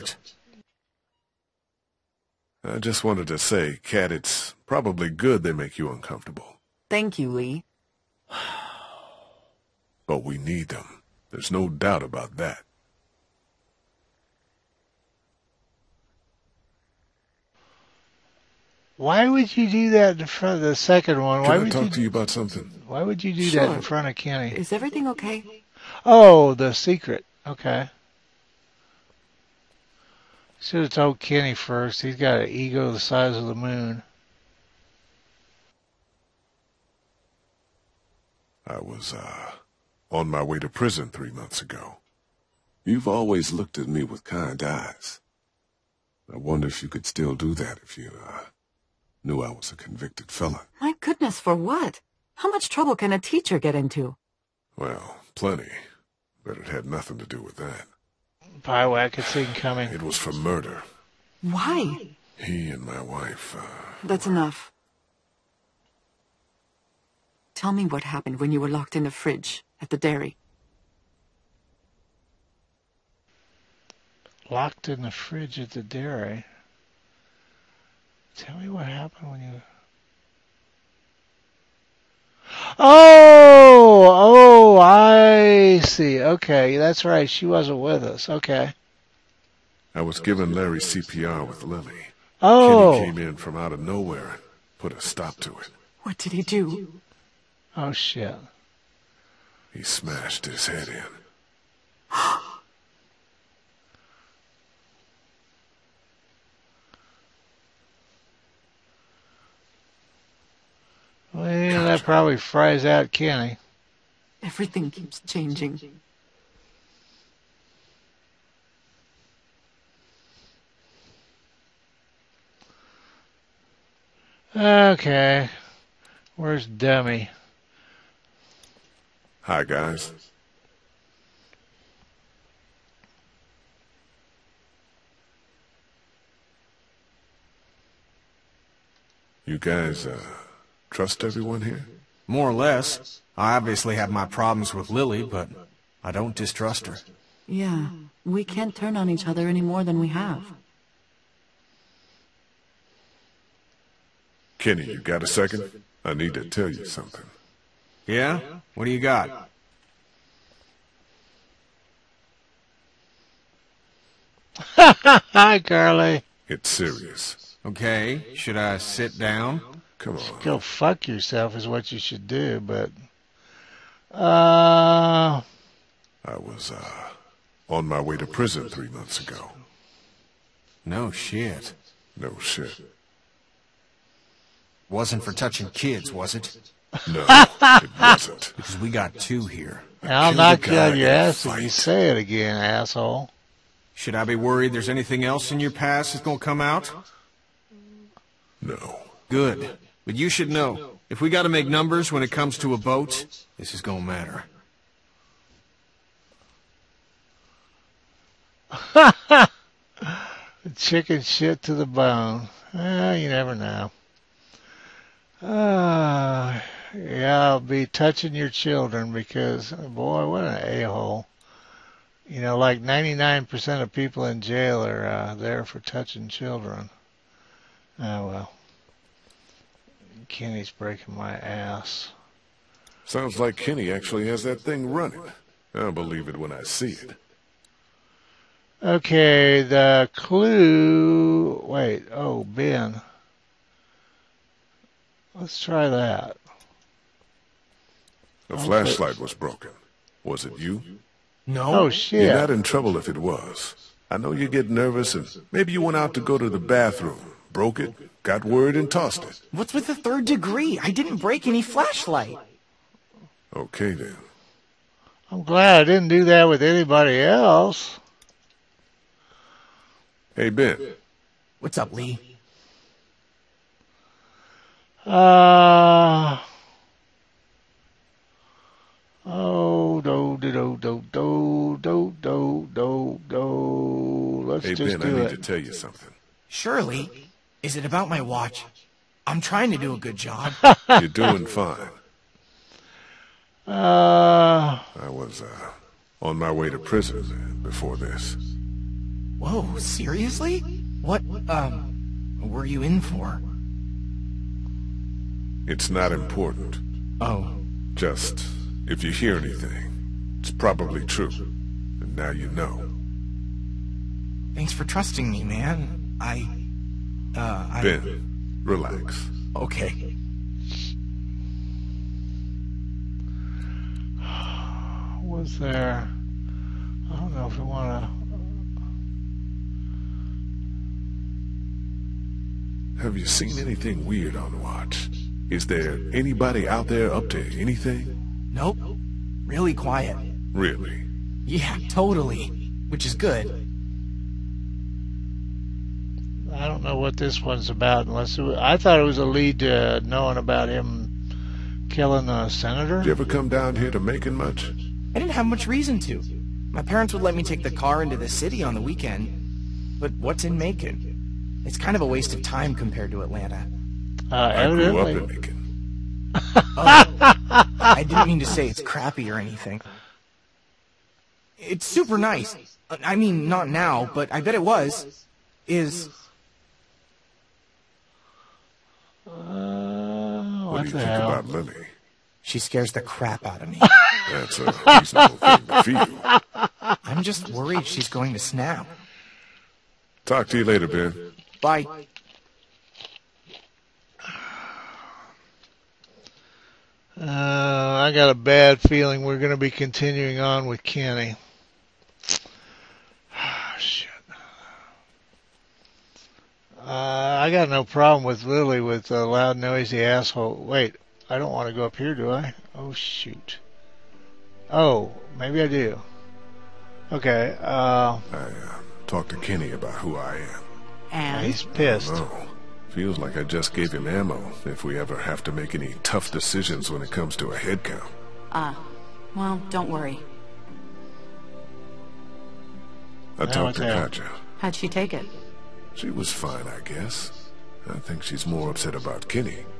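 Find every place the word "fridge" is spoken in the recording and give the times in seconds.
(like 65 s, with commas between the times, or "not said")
69 s, 75 s.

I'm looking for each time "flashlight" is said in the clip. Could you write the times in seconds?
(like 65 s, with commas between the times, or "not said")
248 s, 261 s.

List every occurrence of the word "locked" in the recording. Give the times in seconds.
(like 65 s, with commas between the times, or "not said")
68 s, 74 s.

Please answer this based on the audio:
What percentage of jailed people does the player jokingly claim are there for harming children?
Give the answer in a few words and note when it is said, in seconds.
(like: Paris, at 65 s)
99%, at 222 s.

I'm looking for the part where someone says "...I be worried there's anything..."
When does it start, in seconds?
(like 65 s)
194 s.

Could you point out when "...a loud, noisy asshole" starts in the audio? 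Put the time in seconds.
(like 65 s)
409 s.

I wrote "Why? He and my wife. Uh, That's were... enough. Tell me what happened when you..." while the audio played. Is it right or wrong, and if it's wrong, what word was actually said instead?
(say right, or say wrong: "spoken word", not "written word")
right.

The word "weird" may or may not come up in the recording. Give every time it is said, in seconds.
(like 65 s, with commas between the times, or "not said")
334 s.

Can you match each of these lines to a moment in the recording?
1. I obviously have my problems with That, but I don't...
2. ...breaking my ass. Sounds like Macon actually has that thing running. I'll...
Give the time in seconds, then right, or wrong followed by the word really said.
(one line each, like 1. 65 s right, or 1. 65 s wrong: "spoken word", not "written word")
1. 143 s wrong: "Lilly", not "That"
2. 230 s wrong: "Kenny", not "Macon".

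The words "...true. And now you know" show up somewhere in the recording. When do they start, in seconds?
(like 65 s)
311 s.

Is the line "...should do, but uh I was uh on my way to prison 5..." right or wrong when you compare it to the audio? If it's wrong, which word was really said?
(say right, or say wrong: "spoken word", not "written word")
wrong: "3", not "5".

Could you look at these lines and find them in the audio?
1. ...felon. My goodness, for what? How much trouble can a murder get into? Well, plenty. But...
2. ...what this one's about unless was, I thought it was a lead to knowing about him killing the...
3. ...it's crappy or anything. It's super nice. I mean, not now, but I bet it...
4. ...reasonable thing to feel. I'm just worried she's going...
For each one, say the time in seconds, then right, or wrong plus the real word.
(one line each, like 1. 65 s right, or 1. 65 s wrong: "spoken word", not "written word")
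1. 50 s wrong: "teacher", not "murder"
2. 346 s right
3. 368 s right
4. 384 s right.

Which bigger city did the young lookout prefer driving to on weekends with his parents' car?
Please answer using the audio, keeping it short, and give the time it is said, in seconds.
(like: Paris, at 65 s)
Atlanta, at 363 s.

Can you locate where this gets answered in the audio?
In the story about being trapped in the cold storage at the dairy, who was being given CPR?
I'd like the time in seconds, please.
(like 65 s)
90 s.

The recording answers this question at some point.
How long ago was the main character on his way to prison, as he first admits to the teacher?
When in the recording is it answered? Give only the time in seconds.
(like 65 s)
41 s.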